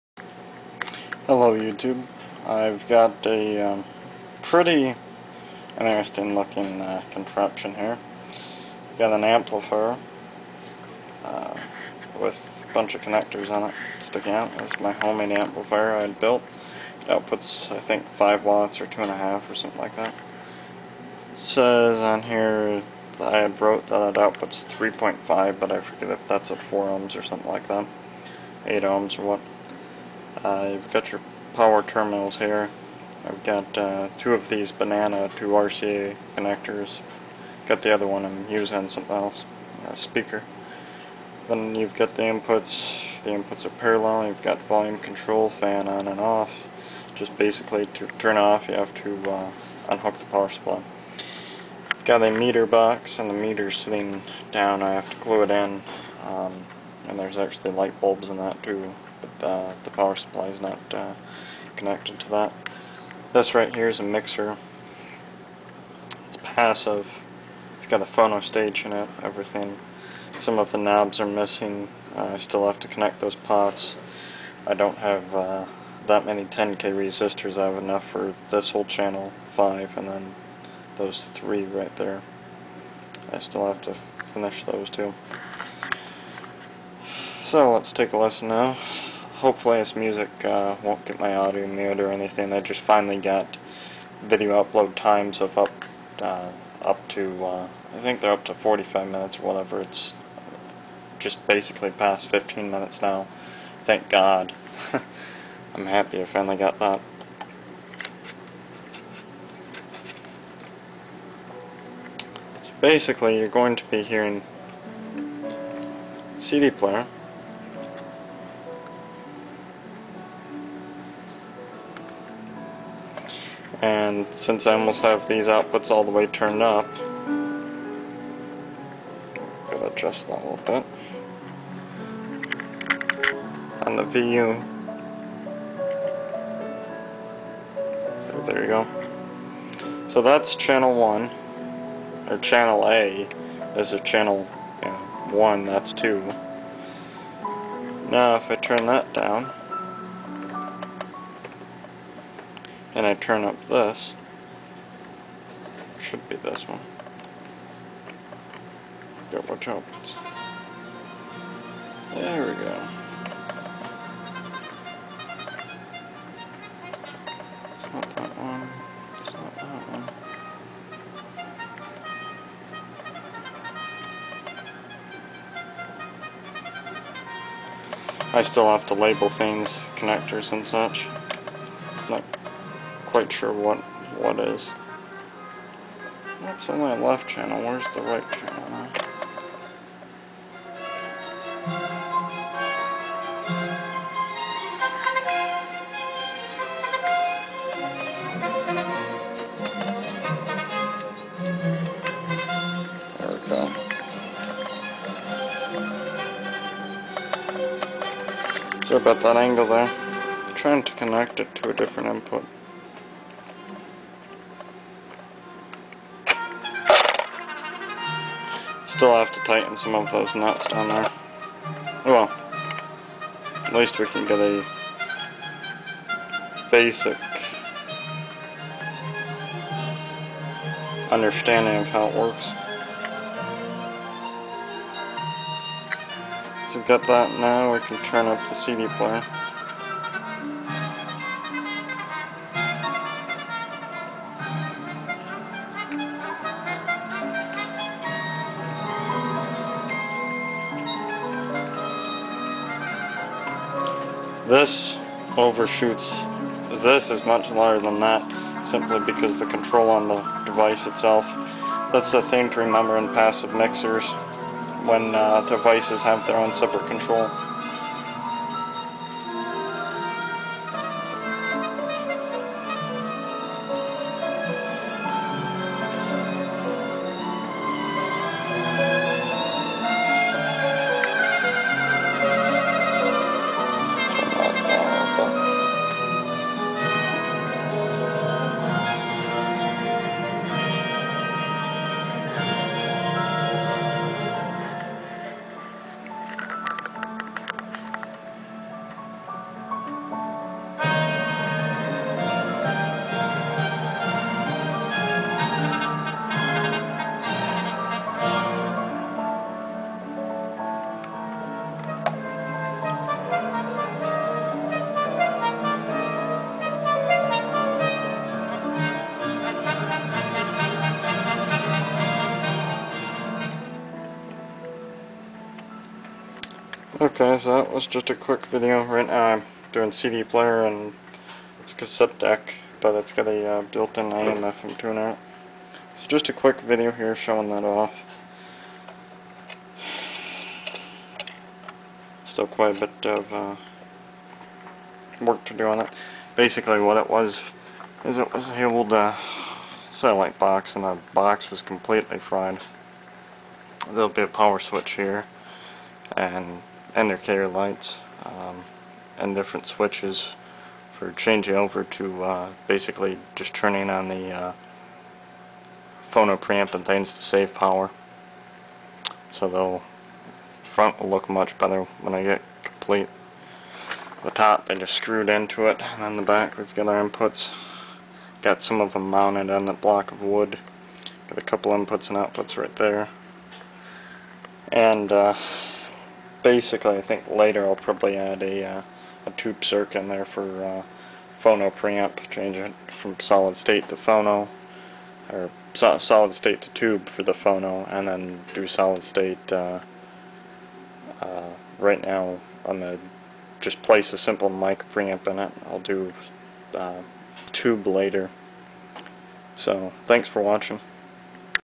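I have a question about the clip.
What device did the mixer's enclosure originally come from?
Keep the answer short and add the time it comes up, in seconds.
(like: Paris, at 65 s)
satellite box, at 349 s.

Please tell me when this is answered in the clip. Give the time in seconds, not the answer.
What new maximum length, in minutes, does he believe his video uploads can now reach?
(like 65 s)
98 s.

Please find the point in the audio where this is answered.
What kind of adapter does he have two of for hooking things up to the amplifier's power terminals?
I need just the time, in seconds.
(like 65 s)
34 s.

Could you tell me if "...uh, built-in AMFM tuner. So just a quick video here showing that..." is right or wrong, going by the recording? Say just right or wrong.
right.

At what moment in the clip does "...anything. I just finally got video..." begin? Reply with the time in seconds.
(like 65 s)
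92 s.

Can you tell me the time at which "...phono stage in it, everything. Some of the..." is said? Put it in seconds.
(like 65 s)
68 s.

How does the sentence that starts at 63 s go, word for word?
This right here is a mixer.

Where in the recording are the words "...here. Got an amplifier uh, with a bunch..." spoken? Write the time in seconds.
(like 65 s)
7 s.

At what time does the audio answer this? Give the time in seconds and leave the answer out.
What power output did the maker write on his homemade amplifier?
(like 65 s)
24 s.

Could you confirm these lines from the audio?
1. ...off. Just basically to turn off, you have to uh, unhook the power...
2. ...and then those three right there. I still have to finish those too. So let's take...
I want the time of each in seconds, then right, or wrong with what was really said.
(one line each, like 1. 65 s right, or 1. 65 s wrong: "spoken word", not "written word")
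1. 46 s right
2. 79 s right.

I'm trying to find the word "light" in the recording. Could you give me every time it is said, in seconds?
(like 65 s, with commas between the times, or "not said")
57 s, 357 s.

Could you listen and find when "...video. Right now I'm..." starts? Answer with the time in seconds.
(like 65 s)
328 s.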